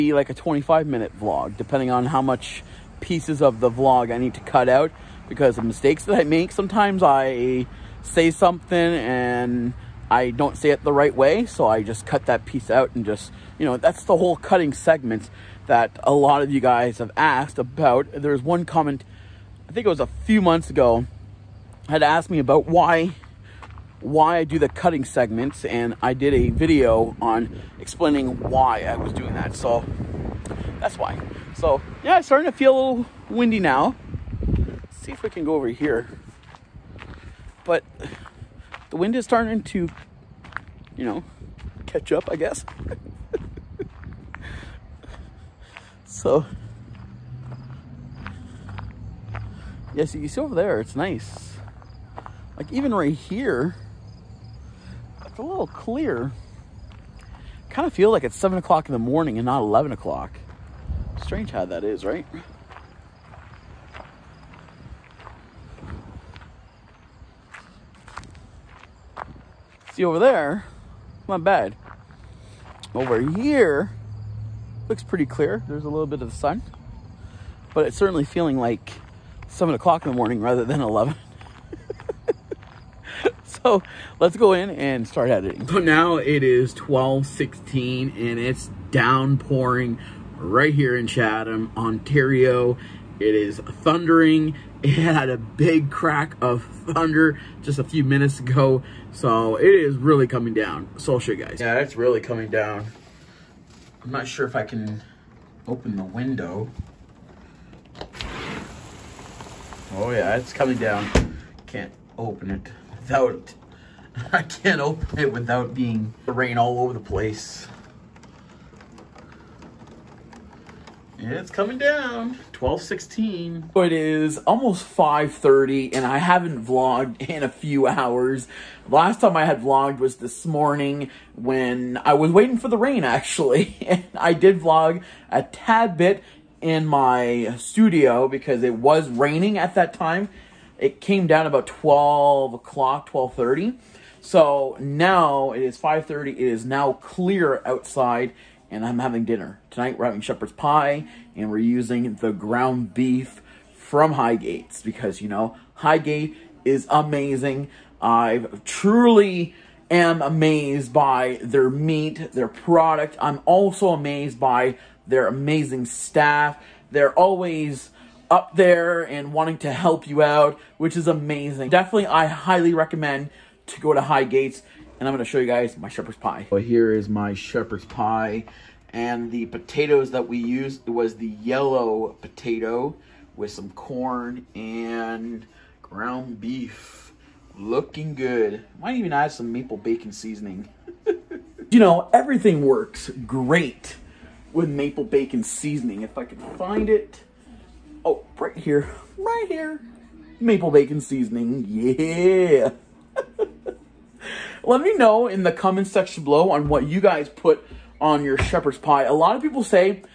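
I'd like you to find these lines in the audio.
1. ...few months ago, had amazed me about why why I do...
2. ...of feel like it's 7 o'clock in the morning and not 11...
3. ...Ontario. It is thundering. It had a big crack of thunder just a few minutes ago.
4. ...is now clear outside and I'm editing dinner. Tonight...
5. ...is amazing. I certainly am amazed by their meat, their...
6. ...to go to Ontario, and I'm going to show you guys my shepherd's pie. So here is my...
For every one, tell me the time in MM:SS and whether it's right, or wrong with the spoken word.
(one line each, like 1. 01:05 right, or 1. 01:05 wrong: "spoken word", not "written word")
1. 00:20 wrong: "asked", not "amazed"
2. 00:57 right
3. 01:31 right
4. 02:26 wrong: "having", not "editing"
5. 02:36 wrong: "truly", not "certainly"
6. 02:53 wrong: "Highgates", not "Ontario".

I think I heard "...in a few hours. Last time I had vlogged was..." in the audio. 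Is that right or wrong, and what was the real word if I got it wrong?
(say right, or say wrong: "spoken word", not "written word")
right.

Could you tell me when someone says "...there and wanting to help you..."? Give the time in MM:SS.
02:48.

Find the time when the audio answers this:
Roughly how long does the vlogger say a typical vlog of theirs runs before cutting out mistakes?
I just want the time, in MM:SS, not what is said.
00:00.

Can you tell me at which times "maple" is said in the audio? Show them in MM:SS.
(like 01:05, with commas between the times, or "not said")
03:09, 03:14, 03:20.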